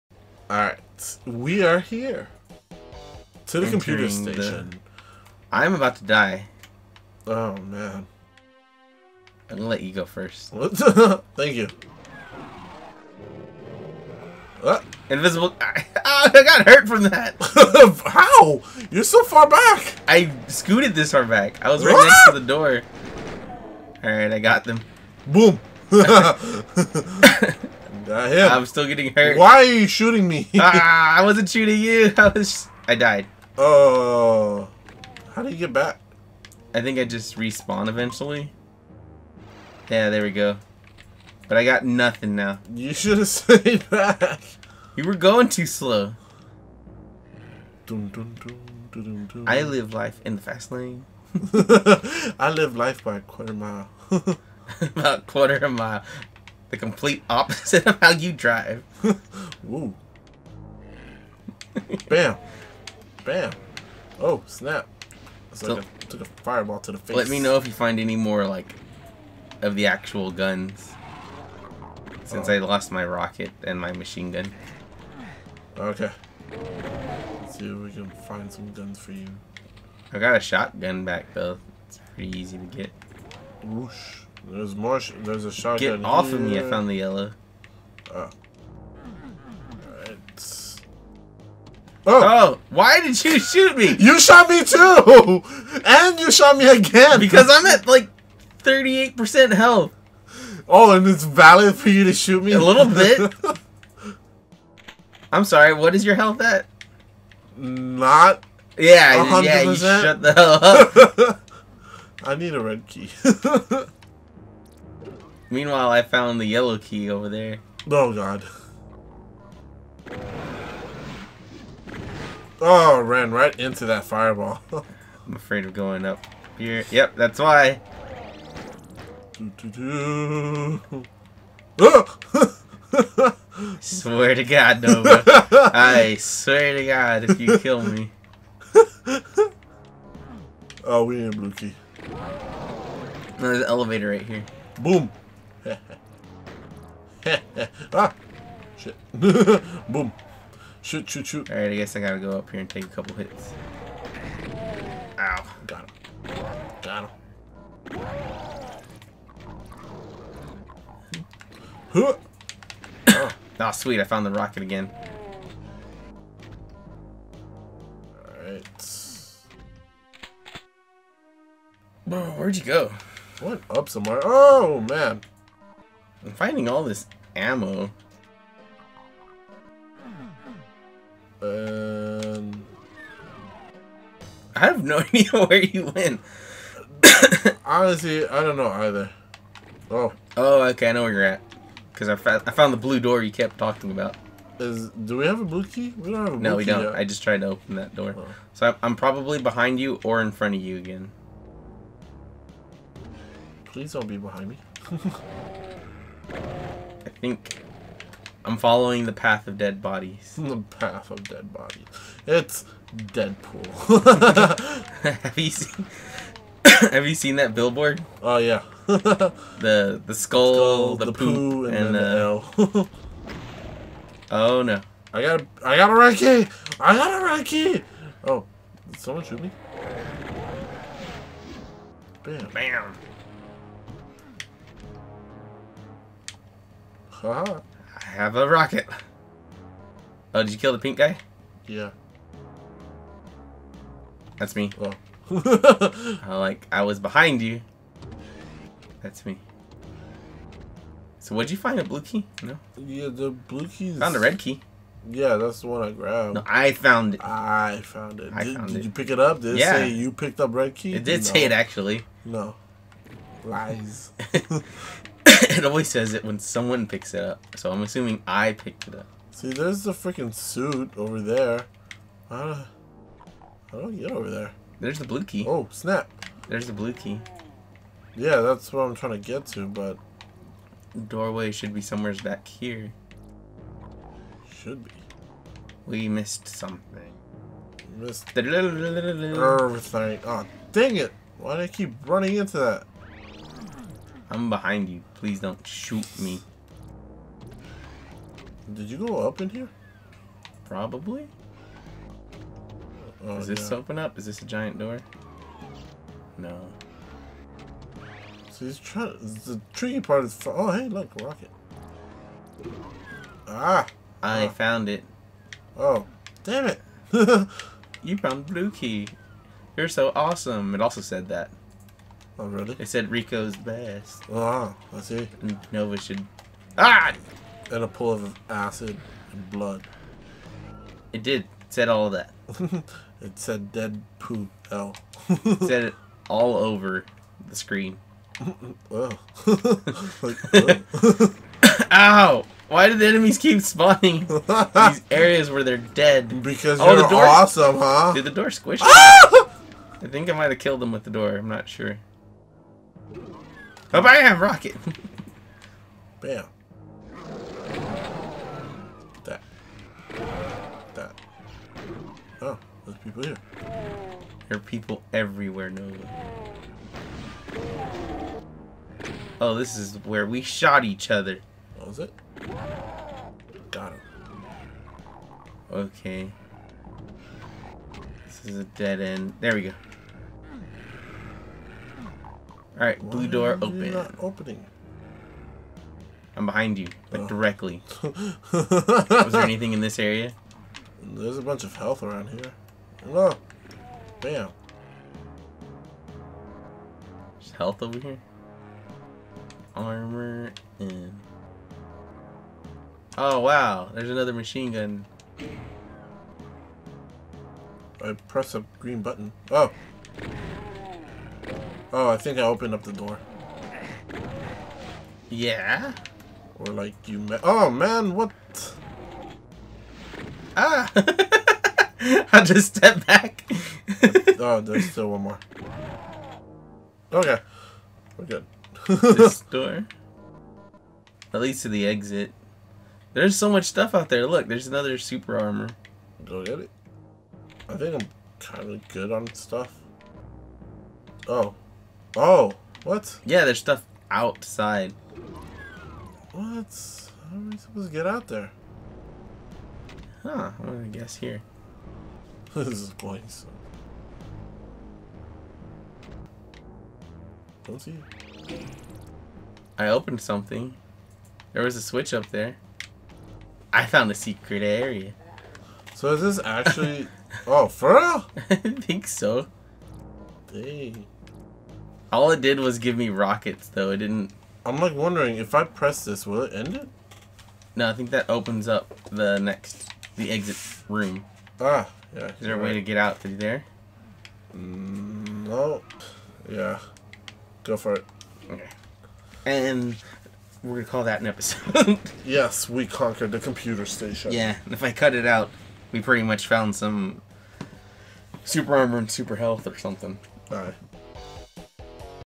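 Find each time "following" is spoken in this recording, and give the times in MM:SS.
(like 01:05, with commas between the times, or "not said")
03:28.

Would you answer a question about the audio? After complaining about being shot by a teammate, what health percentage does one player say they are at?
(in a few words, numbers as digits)
38%.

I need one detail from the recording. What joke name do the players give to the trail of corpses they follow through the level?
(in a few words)
Deadpool.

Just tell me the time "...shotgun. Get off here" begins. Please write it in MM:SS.
01:25.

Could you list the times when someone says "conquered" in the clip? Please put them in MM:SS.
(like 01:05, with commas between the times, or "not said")
08:12.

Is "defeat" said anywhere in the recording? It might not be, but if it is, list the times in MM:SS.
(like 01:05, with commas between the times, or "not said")
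not said.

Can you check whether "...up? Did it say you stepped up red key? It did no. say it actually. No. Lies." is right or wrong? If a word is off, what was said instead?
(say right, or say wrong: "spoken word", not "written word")
wrong: "picked", not "stepped".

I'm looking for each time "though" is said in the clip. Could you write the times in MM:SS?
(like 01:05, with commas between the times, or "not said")
01:21, 07:53.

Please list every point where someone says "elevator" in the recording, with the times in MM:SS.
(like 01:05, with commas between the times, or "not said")
02:23.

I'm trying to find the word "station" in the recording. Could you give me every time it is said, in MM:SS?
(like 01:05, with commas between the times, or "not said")
00:04, 08:13.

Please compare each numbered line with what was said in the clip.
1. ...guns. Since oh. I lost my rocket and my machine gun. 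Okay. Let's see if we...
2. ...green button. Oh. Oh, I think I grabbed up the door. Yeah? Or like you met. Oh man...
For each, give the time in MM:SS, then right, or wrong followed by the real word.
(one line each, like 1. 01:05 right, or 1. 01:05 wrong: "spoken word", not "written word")
1. 01:10 right
2. 06:48 wrong: "opened", not "grabbed".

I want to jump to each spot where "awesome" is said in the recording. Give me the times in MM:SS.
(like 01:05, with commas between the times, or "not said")
05:20, 05:47.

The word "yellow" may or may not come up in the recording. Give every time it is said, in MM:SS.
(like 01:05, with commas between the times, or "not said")
01:26, 01:56.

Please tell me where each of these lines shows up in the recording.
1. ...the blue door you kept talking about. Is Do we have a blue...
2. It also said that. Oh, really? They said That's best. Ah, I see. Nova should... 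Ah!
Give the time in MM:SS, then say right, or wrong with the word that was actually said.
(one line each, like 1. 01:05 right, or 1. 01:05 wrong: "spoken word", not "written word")
1. 03:12 right
2. 05:20 wrong: "Rico", not "That".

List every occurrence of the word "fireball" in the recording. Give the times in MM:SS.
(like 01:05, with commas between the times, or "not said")
01:06, 02:04.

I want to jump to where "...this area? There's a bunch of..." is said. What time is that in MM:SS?
06:29.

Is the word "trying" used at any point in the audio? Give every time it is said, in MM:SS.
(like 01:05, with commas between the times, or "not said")
04:38, 05:08.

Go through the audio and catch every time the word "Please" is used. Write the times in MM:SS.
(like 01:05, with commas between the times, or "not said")
03:23, 04:55.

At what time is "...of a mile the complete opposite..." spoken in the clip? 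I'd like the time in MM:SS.
00:55.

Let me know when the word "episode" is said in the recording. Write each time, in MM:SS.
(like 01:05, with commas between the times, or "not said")
08:11.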